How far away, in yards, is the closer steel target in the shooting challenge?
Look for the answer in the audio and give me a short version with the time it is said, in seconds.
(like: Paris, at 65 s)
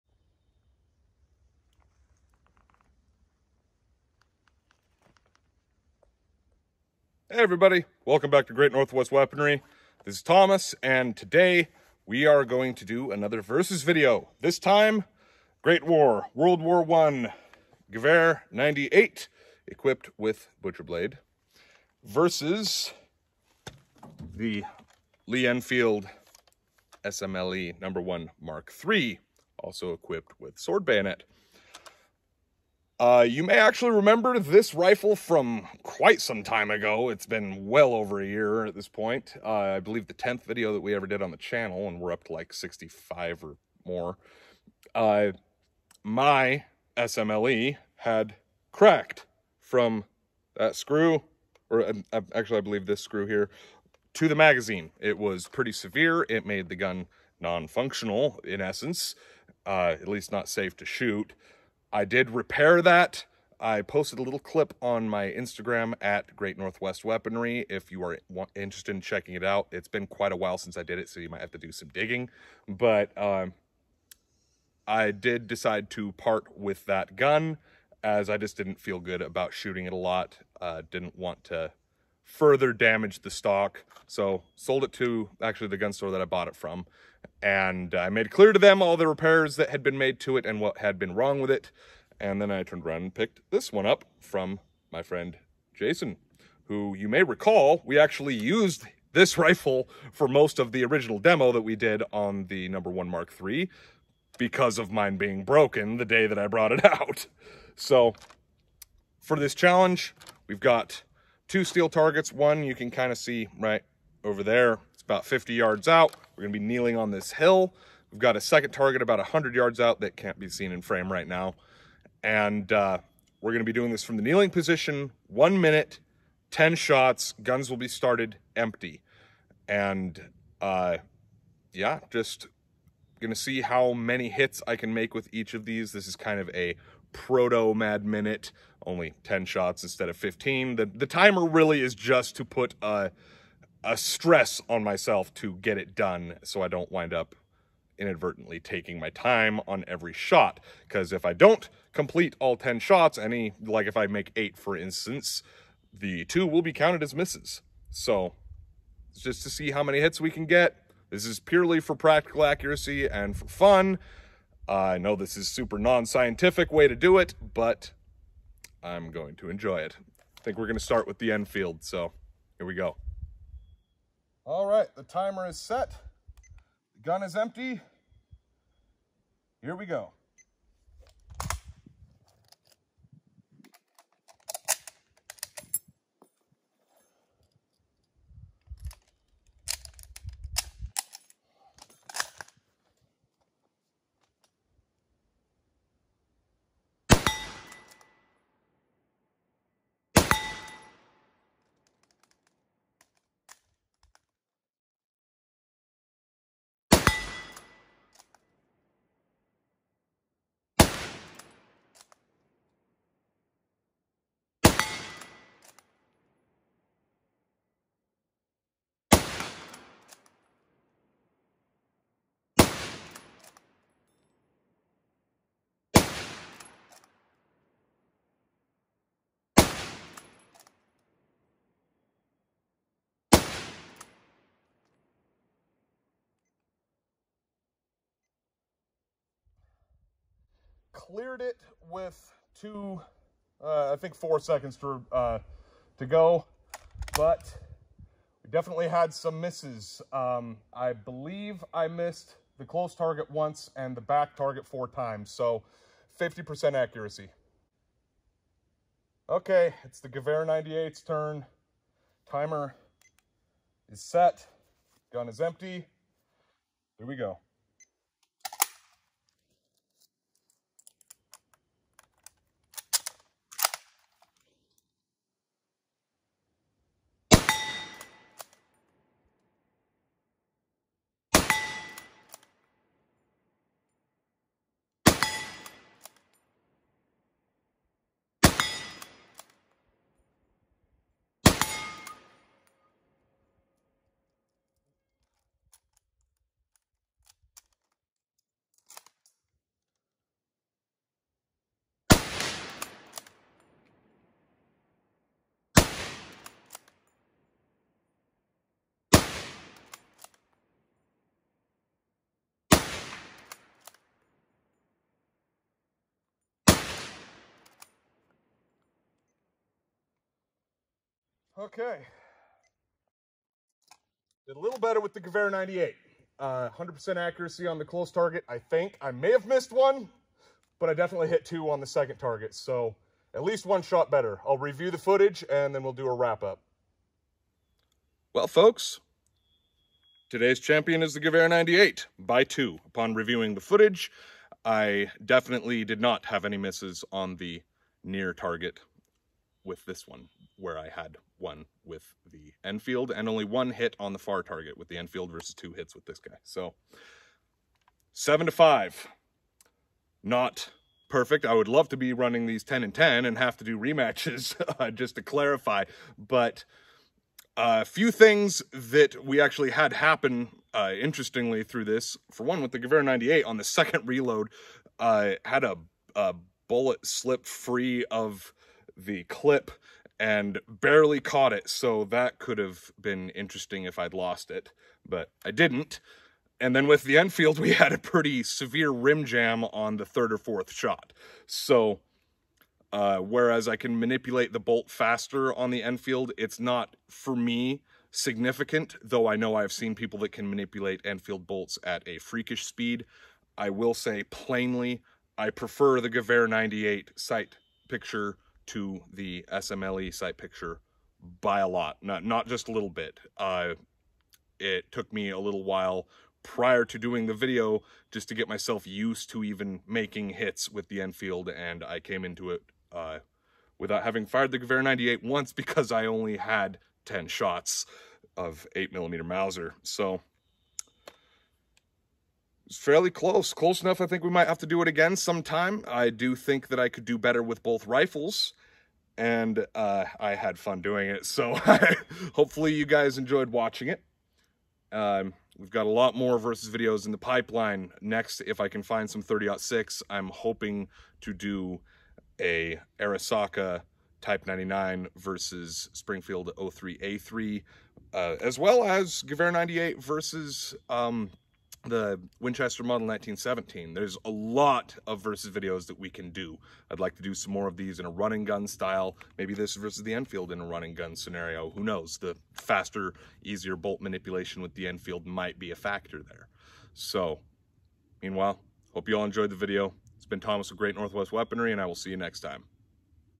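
50 yards, at 115 s.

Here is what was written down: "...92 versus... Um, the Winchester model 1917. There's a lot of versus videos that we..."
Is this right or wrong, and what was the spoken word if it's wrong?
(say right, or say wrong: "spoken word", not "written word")
wrong: "98", not "92".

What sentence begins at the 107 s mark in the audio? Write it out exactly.
So for this challenge, we've got two steel targets.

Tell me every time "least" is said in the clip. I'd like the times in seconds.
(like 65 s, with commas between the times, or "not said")
60 s, 333 s.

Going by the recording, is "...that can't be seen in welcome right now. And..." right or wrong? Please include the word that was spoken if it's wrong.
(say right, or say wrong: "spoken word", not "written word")
wrong: "frame", not "welcome".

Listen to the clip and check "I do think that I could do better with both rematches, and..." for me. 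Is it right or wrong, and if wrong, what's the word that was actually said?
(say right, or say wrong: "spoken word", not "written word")
wrong: "rifles", not "rematches".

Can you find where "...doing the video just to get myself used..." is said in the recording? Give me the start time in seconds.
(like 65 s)
416 s.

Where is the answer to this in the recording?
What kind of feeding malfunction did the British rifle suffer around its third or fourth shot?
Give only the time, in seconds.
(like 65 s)
388 s.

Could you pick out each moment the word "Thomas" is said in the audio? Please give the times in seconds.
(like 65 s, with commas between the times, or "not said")
10 s, 480 s.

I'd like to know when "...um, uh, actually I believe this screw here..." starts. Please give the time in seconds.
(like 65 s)
51 s.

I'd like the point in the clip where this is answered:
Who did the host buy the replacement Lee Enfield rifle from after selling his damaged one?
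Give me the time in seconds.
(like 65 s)
95 s.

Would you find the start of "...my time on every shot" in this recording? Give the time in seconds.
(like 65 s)
148 s.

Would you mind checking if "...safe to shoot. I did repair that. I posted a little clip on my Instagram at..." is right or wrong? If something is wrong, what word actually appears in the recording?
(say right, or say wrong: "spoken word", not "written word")
right.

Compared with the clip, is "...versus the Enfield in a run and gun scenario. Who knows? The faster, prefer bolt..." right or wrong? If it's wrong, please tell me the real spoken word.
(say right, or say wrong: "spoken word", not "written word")
wrong: "easier", not "prefer".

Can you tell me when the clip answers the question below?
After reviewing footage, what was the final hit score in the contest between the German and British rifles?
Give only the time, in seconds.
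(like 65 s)
358 s.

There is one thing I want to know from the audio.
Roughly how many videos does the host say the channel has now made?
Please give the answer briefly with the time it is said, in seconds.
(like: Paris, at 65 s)
65, at 42 s.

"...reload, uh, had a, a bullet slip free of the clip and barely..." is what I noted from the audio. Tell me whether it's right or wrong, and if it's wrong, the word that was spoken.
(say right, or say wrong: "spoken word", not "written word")
right.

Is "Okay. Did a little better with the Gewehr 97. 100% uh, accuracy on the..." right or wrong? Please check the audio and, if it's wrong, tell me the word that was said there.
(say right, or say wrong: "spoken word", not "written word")
wrong: "98", not "97".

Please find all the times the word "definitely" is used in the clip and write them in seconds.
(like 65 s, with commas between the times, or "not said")
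248 s, 330 s, 345 s.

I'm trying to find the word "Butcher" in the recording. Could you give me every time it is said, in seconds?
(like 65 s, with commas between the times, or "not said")
20 s.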